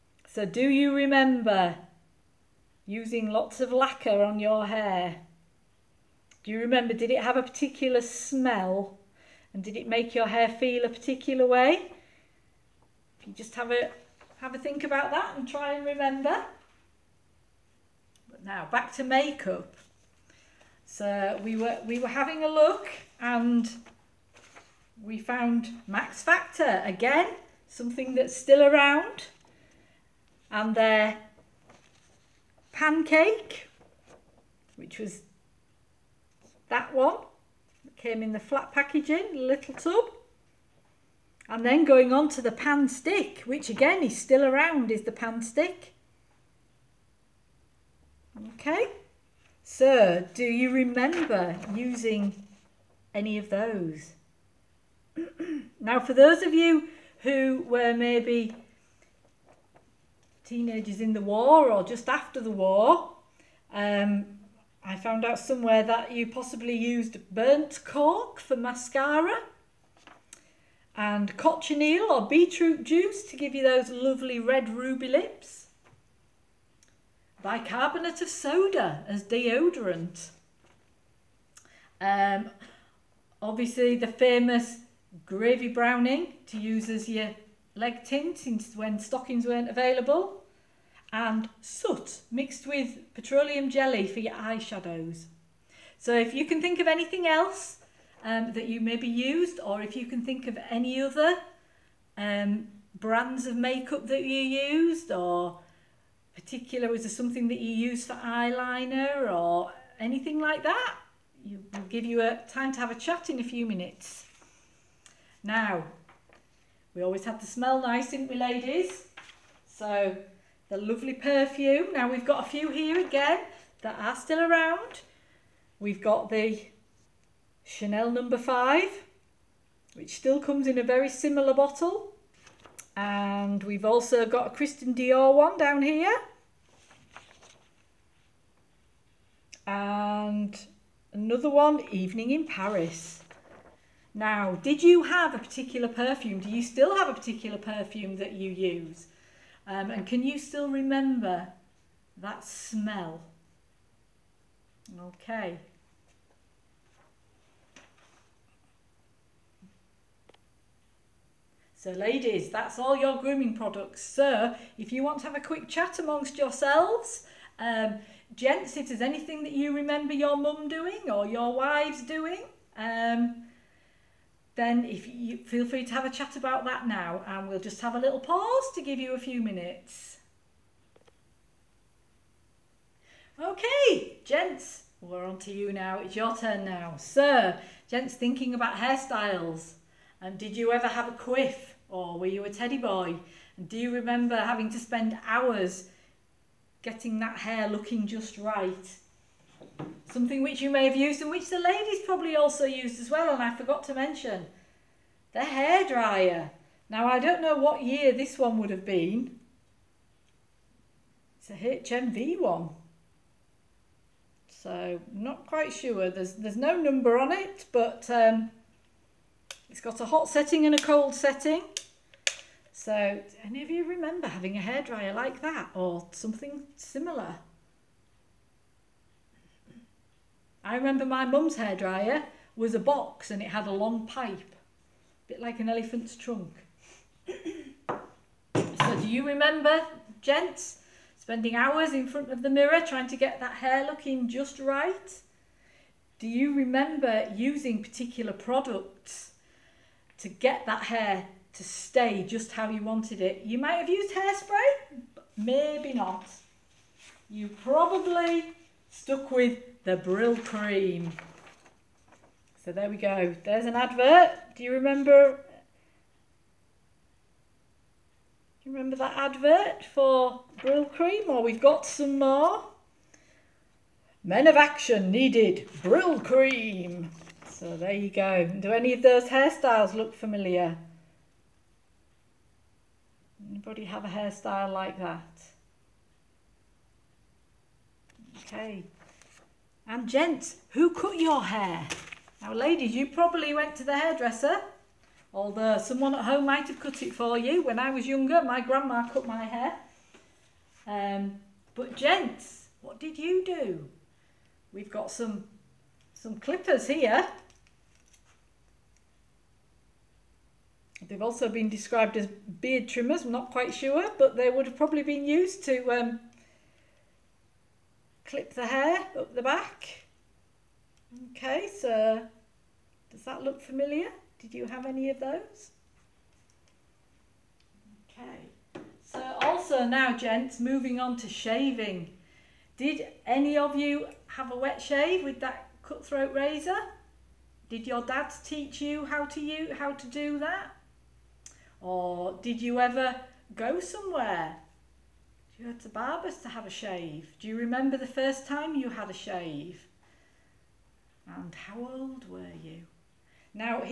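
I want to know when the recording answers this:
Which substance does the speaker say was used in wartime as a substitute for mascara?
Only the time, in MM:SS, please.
01:07.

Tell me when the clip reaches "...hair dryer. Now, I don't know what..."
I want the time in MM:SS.
03:25.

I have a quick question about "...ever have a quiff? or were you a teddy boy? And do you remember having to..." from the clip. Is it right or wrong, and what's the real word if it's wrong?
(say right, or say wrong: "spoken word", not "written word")
right.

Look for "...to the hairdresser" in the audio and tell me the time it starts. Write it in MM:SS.
04:53.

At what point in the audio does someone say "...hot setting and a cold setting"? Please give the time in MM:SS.
03:40.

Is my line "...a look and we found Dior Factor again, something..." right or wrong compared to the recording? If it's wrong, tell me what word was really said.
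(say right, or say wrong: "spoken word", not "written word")
wrong: "Max", not "Dior".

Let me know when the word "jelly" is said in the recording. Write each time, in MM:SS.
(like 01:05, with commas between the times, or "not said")
01:33.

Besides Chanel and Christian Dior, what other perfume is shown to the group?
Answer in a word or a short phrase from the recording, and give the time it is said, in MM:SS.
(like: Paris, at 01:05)
Evening in Paris, at 02:21.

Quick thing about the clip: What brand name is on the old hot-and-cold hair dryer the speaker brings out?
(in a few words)
HMV.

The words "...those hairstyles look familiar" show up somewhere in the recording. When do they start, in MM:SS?
04:39.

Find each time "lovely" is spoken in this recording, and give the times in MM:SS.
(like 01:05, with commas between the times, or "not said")
01:13, 02:00.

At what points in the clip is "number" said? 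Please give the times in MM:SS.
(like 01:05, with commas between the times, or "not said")
02:08, 03:36.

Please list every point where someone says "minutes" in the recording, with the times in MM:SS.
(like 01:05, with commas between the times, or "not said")
01:53, 02:59.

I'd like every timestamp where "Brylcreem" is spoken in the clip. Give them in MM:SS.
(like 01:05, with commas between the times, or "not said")
04:19, 04:30, 04:35.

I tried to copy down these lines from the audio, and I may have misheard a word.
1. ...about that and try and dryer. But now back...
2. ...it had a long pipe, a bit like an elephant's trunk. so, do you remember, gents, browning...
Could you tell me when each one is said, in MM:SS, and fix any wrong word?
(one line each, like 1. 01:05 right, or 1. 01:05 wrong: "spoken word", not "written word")
1. 00:14 wrong: "remember", not "dryer"
2. 03:53 wrong: "spending", not "browning".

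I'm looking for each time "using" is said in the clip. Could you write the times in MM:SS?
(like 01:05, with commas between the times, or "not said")
00:02, 00:51, 04:07.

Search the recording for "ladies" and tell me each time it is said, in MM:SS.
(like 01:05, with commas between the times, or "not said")
01:58, 02:41, 03:21, 04:52.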